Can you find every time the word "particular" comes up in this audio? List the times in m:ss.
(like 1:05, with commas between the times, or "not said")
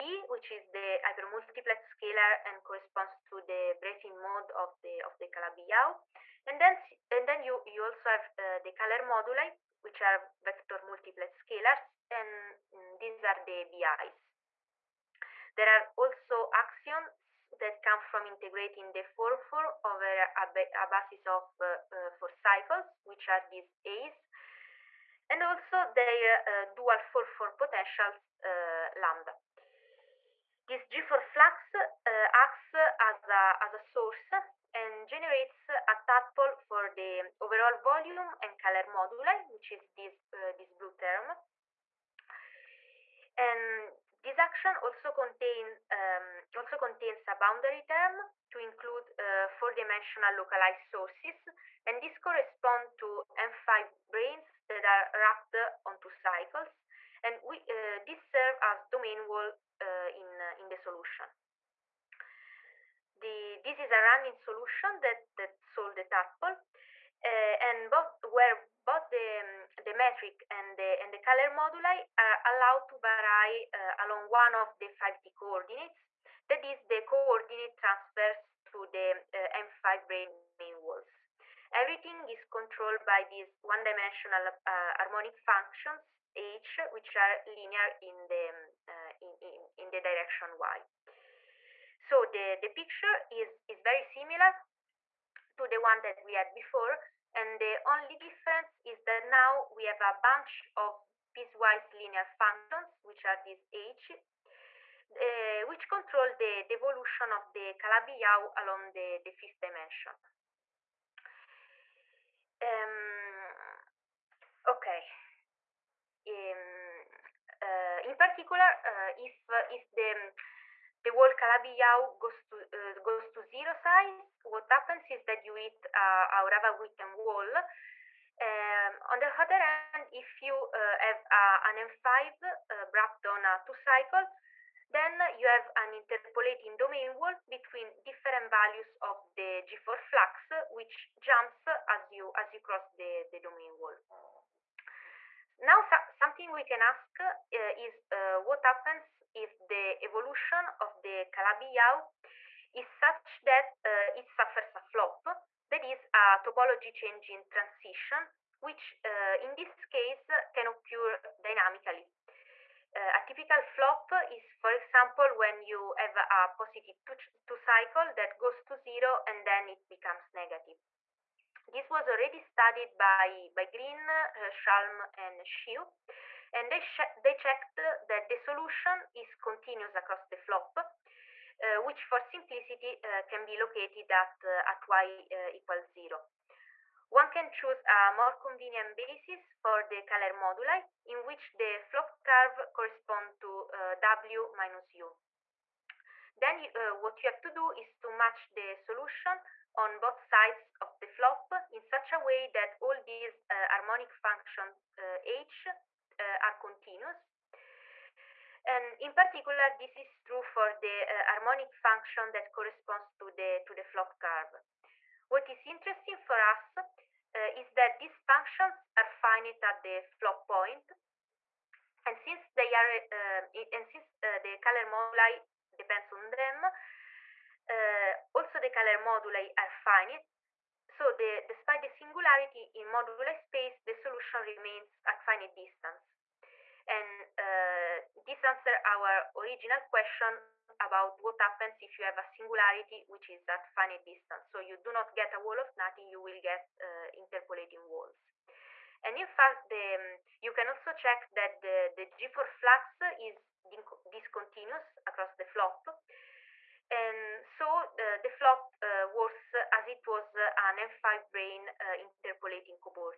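1:58, 3:29.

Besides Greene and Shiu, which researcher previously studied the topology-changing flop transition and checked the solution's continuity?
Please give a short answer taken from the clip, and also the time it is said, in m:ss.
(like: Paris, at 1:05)
Schalm, at 2:54.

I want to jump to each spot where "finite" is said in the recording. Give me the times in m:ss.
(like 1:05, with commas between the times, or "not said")
3:39, 3:49, 3:55, 4:03.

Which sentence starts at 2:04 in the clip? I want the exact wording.
What happens is that you eat uh, a Witten wall.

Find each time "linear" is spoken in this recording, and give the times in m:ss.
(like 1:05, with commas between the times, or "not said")
1:27, 1:41.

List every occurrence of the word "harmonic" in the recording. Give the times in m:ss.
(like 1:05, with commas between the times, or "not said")
1:24, 3:23, 3:31.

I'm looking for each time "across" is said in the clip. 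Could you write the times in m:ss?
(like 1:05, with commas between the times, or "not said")
2:59, 4:15.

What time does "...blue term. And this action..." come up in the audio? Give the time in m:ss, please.
0:40.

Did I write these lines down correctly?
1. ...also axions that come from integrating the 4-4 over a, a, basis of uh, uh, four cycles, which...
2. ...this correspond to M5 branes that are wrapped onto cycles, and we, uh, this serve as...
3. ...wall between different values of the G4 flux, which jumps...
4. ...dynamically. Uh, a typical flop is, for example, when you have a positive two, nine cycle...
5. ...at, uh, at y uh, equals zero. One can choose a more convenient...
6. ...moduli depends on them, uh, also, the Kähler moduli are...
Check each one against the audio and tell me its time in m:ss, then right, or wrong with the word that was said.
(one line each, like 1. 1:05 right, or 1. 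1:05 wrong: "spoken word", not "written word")
1. 0:15 right
2. 0:52 right
3. 2:17 right
4. 2:41 wrong: "two", not "nine"
5. 3:04 right
6. 3:44 right.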